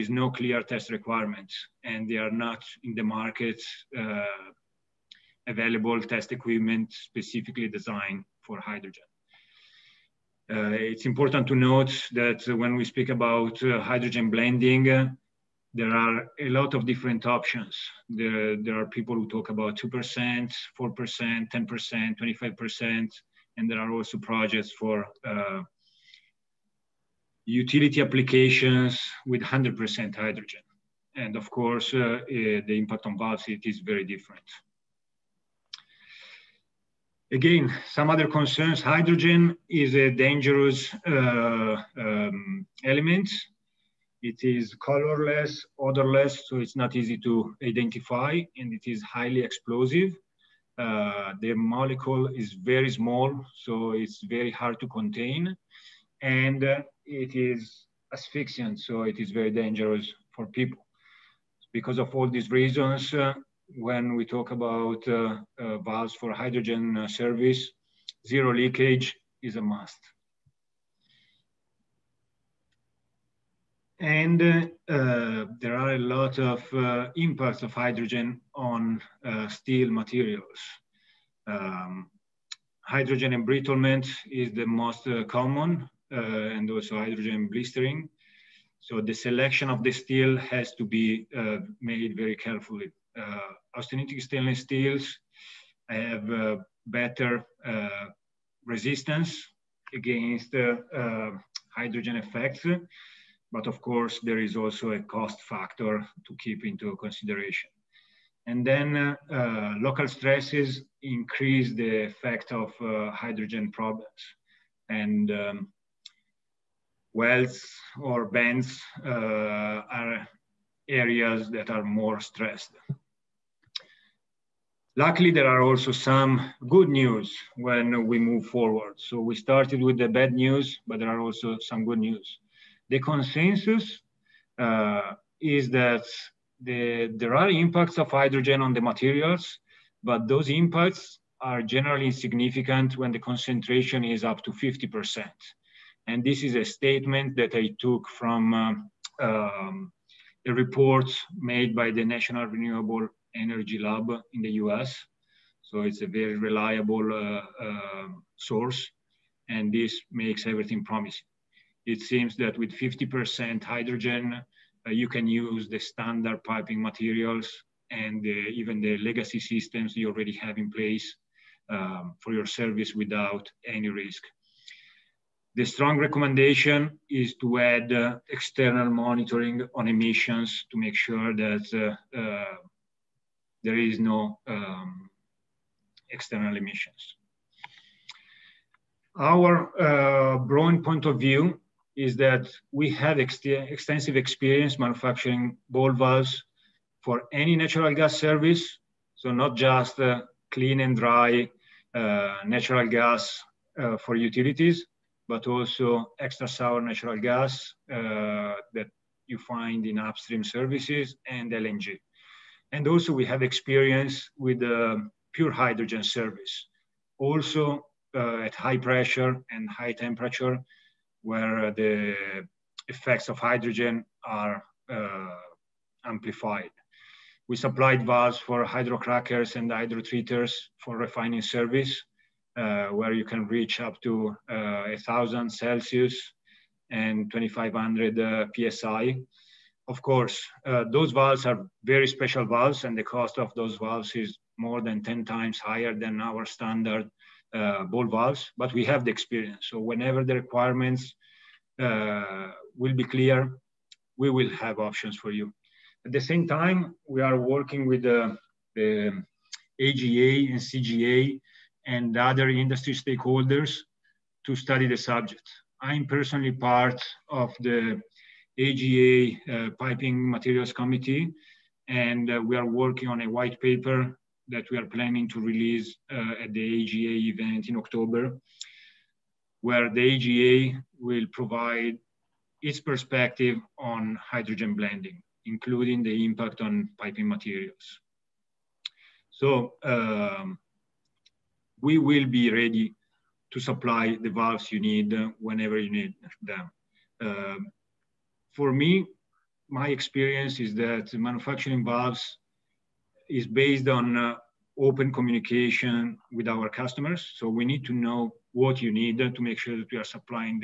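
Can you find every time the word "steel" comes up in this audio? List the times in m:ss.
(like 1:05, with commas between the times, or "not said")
1:19, 1:29, 1:34.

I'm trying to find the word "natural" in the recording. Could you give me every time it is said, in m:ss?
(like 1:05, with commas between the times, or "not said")
3:17, 3:22, 3:26.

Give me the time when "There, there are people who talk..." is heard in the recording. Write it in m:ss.
0:18.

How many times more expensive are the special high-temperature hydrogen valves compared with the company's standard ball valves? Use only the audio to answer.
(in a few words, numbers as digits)
more than 10 times.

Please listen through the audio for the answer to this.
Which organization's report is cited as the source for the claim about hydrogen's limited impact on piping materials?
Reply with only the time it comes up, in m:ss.
2:32.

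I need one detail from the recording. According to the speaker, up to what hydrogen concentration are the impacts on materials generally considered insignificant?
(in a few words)
50 percent.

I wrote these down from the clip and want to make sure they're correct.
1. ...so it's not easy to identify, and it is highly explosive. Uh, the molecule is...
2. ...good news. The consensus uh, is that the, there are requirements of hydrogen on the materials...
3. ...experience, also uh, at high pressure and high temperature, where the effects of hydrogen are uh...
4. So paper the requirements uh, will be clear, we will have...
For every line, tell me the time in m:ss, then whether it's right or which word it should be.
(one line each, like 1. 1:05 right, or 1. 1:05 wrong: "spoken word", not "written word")
1. 0:46 right
2. 2:11 wrong: "impacts", not "requirements"
3. 3:36 wrong: "service", not "experience"
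4. 4:09 wrong: "whenever", not "paper".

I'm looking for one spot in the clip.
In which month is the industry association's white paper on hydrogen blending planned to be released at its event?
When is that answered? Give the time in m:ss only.
4:37.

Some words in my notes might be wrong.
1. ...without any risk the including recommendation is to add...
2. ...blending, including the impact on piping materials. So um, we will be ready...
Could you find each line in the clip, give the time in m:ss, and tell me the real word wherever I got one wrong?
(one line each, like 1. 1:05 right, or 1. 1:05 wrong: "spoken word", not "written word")
1. 2:52 wrong: "strong", not "including"
2. 4:44 right.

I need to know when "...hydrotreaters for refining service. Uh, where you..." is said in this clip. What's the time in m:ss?
3:49.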